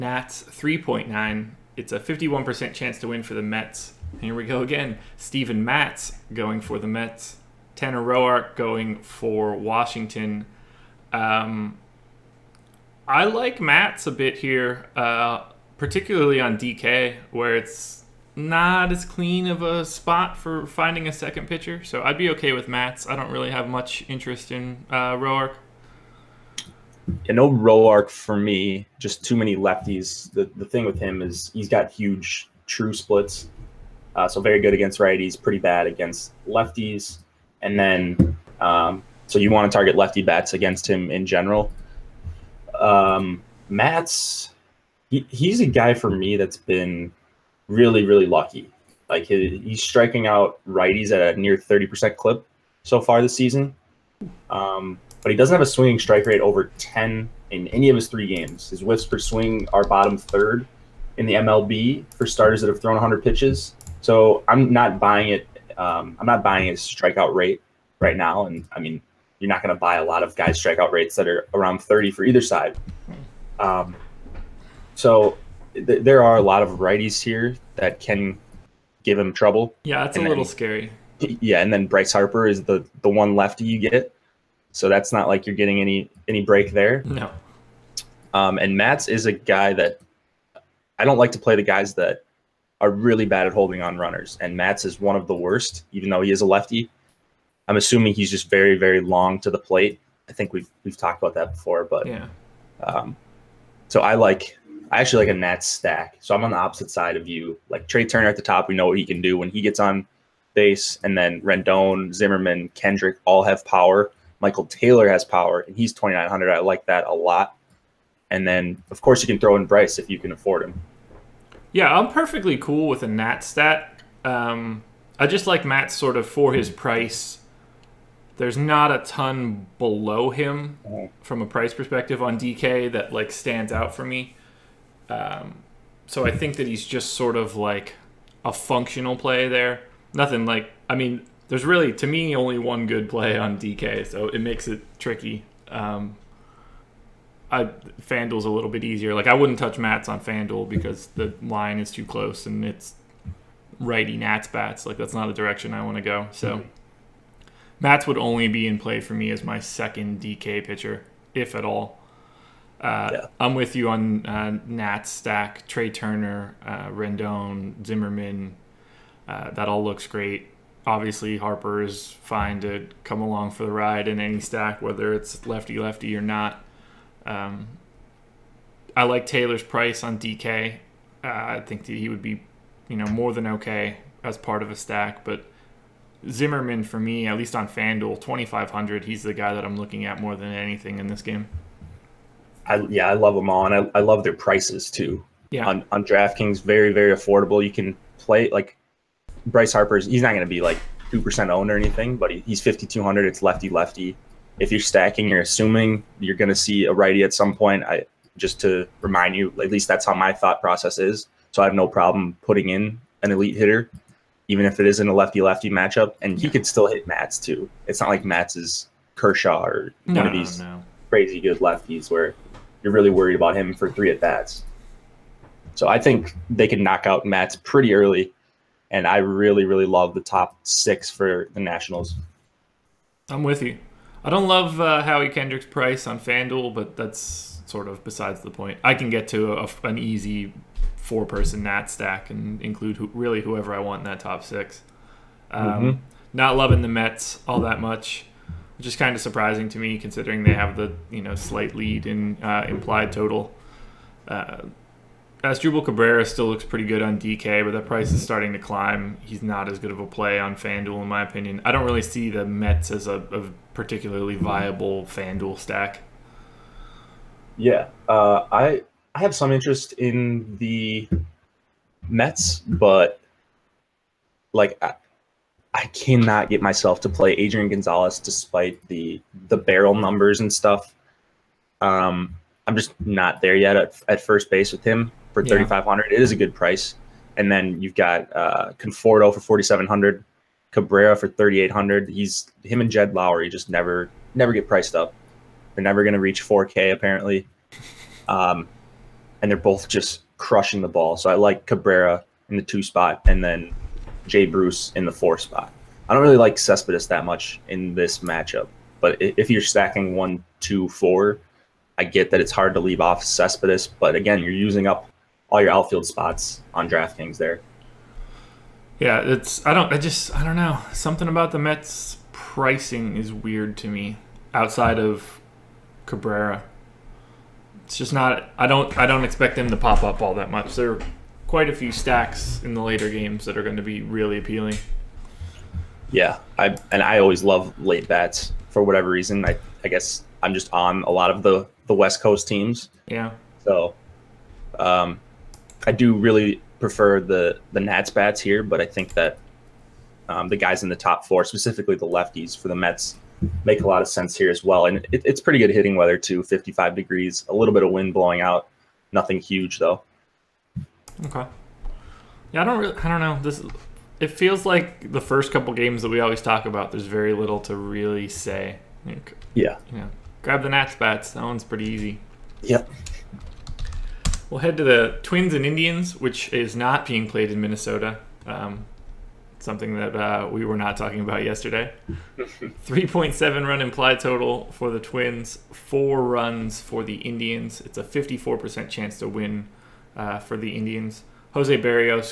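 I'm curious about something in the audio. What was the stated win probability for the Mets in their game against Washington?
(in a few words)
51%.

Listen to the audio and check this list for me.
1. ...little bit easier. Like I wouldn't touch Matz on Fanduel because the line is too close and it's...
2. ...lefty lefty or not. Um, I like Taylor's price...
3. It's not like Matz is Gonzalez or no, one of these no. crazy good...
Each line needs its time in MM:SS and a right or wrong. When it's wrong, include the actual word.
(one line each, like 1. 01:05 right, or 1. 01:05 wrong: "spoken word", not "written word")
1. 02:28 right
2. 02:55 right
3. 03:37 wrong: "Kershaw", not "Gonzalez".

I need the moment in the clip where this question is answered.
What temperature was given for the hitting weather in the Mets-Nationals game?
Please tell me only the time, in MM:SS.
05:56.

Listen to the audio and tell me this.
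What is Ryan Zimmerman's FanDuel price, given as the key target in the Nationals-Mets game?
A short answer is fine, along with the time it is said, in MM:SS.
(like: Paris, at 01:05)
2500, at 03:08.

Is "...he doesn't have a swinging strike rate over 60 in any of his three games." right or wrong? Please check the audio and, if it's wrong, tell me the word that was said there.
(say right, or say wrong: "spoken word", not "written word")
wrong: "10", not "60".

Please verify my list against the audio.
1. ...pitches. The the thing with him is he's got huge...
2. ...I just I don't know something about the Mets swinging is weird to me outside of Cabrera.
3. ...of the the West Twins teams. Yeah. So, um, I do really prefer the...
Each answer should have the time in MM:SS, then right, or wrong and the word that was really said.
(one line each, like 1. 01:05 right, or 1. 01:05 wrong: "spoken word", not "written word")
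1. 00:29 wrong: "lefties", not "pitches"
2. 05:19 wrong: "pricing", not "swinging"
3. 05:41 wrong: "Coast", not "Twins".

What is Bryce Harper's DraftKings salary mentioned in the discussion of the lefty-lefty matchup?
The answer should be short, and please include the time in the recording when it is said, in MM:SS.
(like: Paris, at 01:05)
5,200, at 03:22.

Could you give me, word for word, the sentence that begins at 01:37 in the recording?
I'm assuming he's just very very long to the plate.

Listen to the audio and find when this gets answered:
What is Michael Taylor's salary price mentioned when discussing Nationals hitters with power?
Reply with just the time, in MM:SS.
01:55.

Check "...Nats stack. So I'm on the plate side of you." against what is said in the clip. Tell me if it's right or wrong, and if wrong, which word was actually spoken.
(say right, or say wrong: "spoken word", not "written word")
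wrong: "opposite", not "plate".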